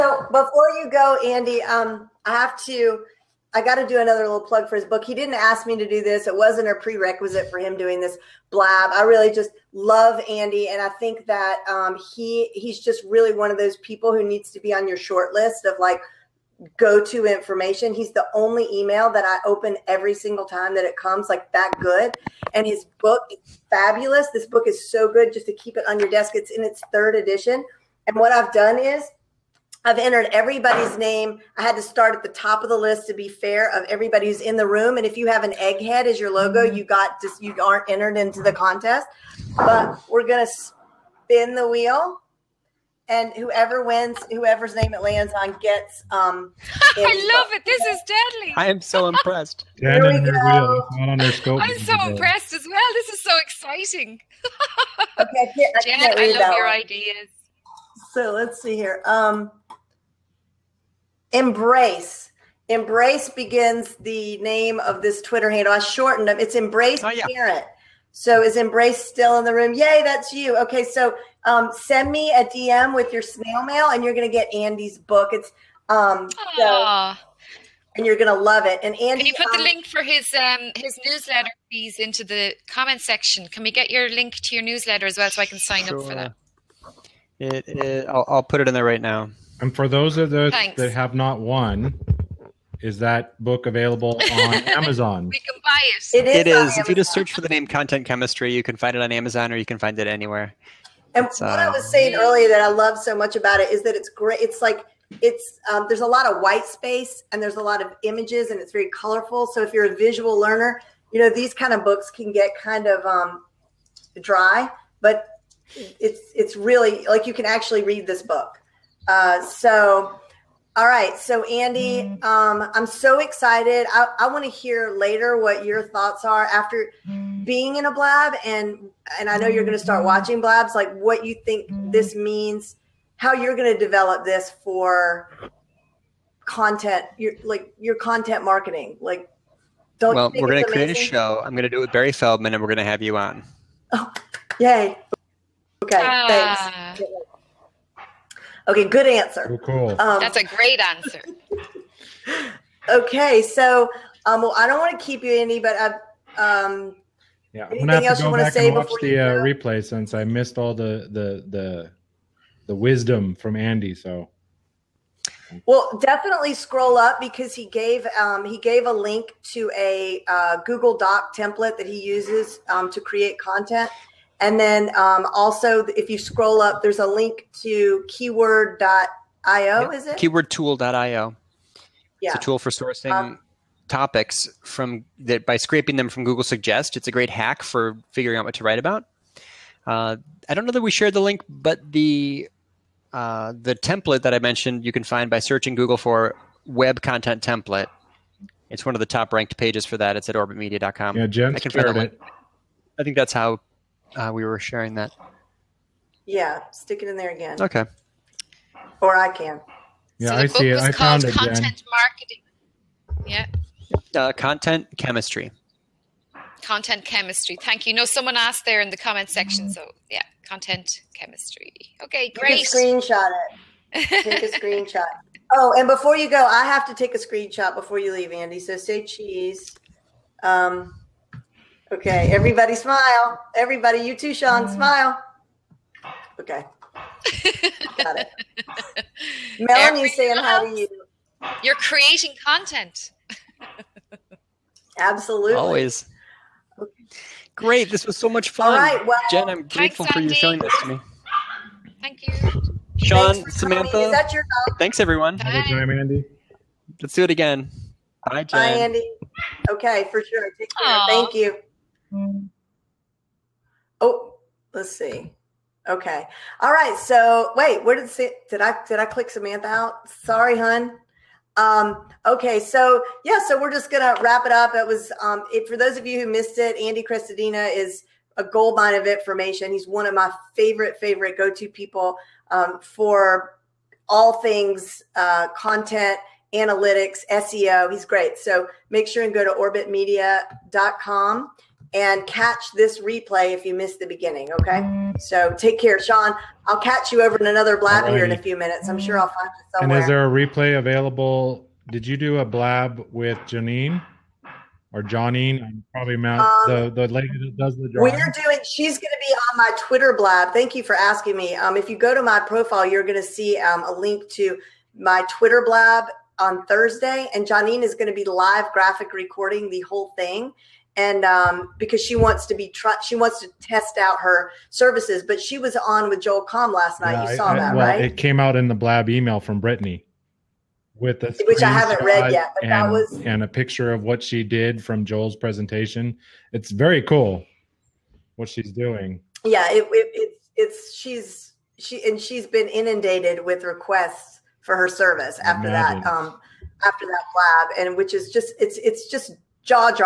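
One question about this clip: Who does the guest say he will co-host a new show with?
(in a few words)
Barry Feldman.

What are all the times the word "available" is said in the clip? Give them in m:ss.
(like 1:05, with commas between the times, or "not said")
1:33, 5:00.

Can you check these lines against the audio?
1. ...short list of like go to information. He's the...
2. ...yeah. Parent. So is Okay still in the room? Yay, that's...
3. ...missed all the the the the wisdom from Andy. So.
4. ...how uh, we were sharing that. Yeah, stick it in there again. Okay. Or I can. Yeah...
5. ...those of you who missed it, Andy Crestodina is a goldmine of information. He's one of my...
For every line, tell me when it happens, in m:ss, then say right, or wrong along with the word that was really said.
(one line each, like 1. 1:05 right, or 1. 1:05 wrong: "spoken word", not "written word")
1. 0:14 right
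2. 1:07 wrong: "Embrace", not "Okay"
3. 2:40 right
4. 3:23 right
5. 4:35 right.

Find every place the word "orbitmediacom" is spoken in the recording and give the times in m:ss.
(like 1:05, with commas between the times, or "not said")
3:20, 4:49.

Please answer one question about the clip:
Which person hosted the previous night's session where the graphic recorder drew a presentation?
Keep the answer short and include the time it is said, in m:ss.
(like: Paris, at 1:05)
Joel Comm, at 5:26.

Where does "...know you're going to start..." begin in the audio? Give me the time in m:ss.
2:09.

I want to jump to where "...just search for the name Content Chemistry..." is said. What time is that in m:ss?
1:36.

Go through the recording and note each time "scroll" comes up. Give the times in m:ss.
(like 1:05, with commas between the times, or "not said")
2:46, 2:56.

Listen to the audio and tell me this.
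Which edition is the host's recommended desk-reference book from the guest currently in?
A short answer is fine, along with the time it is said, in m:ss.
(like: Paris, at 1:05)
third edition, at 0:26.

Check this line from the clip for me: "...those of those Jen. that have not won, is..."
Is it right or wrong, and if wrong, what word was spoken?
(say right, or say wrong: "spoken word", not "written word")
wrong: "Thanks", not "Jen".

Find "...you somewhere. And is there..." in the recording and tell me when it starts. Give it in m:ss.
4:59.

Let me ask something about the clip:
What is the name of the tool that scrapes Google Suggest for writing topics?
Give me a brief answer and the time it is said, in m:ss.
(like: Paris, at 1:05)
Keywordtool.io, at 3:00.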